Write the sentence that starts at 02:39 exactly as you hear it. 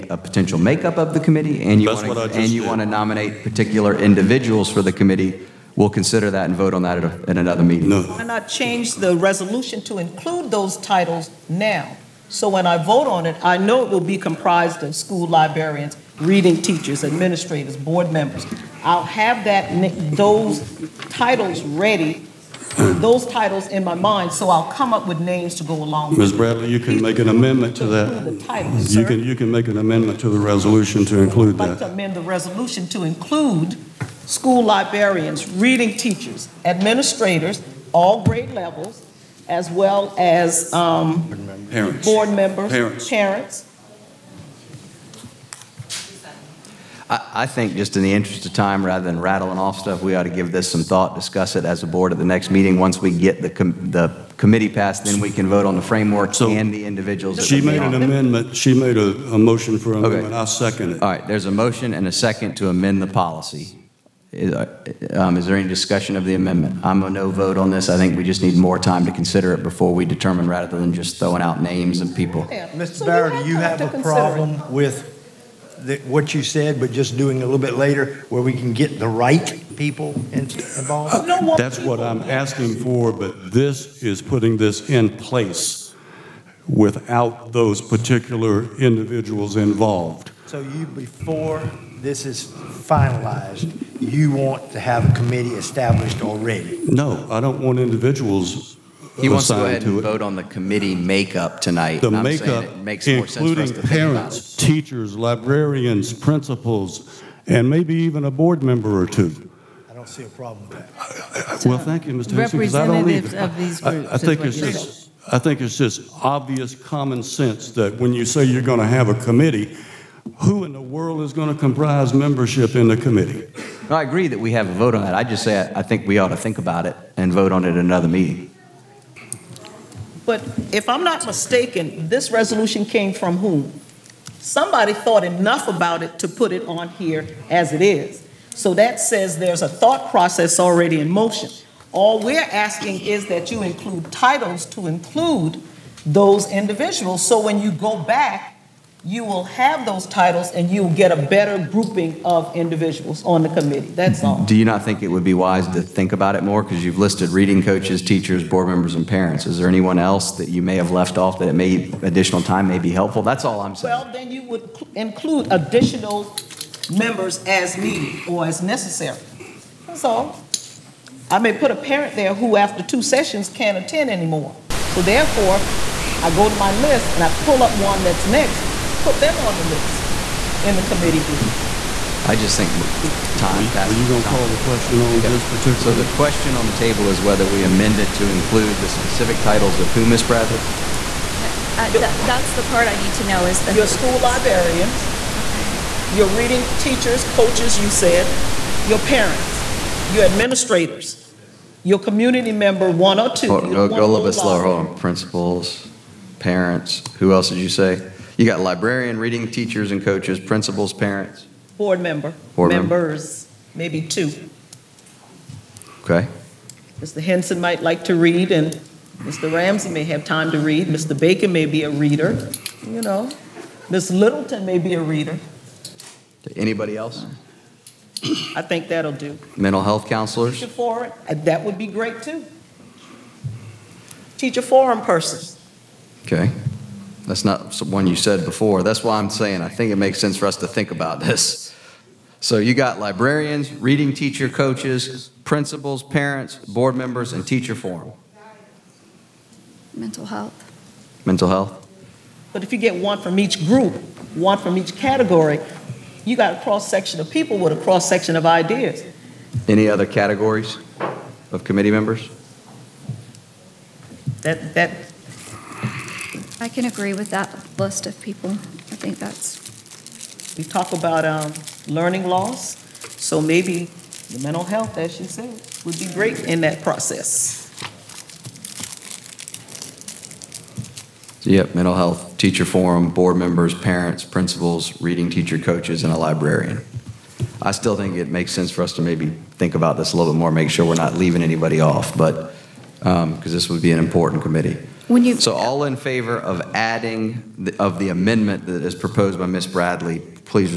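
Is there anyone else that you may have left off that it may additional time may be helpful?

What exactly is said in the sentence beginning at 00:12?
So when I vote on it, I know it will be comprised of school librarians, reading teachers, administrators, board members.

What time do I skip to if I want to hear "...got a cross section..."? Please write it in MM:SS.
04:16.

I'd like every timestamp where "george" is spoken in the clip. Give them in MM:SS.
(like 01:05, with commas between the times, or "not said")
not said.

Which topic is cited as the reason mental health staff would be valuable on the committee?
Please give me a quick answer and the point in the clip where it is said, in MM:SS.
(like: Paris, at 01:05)
learning loss, at 04:31.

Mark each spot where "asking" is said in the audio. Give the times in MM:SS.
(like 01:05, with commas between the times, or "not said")
01:22, 02:22.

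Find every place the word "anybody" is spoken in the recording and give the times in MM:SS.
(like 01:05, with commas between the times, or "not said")
03:46, 04:51.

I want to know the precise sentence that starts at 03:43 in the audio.
Miss Littleton may be a reader.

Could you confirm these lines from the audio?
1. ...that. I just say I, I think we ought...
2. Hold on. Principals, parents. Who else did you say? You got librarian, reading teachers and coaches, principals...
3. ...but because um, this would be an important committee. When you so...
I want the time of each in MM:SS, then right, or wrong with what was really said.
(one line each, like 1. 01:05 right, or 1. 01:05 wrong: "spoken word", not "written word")
1. 02:05 right
2. 03:24 right
3. 04:52 right.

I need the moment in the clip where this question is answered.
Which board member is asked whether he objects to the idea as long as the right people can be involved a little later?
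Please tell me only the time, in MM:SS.
01:12.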